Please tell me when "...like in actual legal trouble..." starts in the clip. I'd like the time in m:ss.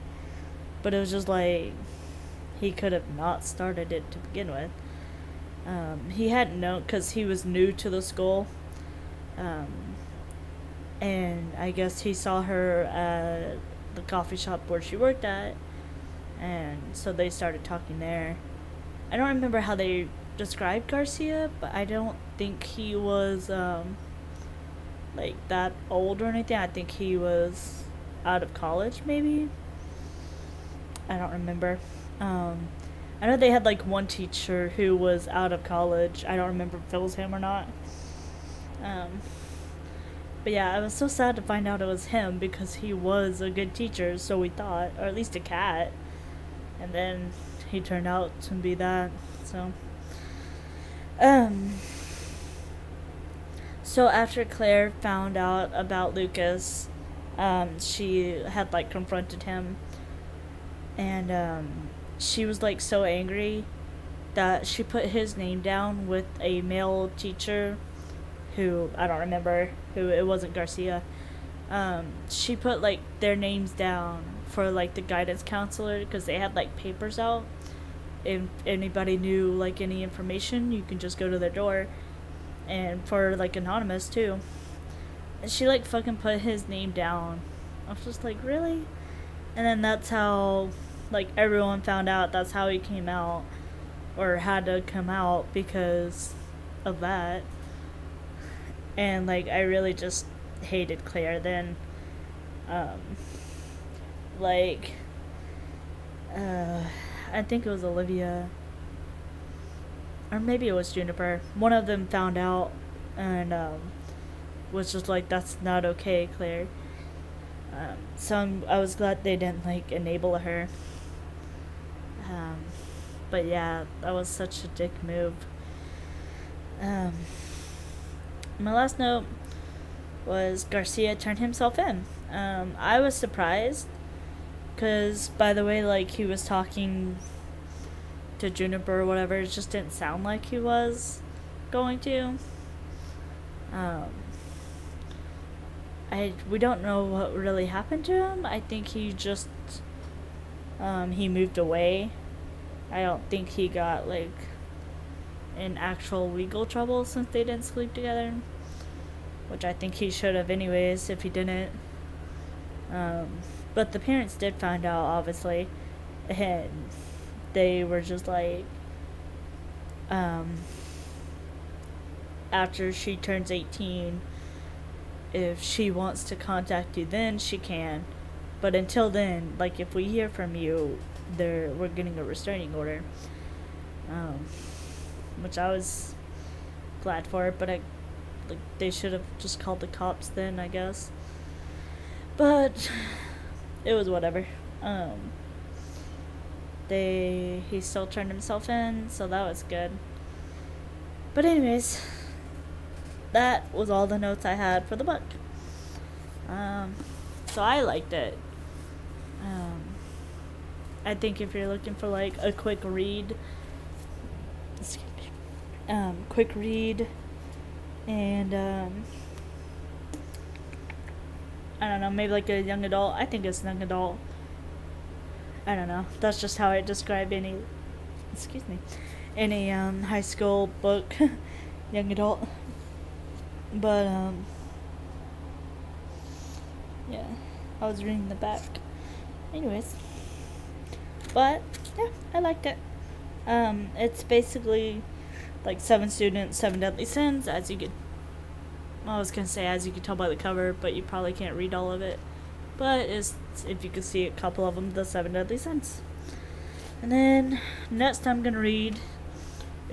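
2:34.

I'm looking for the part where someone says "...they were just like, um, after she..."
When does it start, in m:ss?
2:47.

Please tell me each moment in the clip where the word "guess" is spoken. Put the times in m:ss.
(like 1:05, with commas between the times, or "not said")
0:11, 3:10.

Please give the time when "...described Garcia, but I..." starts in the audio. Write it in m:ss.
0:20.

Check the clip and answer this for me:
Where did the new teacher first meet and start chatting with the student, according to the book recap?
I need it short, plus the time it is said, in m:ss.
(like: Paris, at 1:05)
coffee shop, at 0:14.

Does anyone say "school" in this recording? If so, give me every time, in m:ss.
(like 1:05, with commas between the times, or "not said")
0:08, 3:50.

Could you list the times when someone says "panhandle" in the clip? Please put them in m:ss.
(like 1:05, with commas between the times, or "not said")
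not said.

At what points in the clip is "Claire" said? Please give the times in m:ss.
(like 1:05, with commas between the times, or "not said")
0:54, 1:41, 1:56.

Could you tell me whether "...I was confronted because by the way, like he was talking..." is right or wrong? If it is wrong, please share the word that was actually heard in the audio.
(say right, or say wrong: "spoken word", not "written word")
wrong: "surprised", not "confronted".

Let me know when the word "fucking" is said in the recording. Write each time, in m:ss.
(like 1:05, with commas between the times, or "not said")
1:25.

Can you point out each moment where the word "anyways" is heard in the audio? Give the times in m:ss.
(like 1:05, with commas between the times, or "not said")
2:40, 3:21, 3:59.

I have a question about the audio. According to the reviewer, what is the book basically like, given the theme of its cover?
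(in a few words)
Seven Students, Seven Deadly Sins.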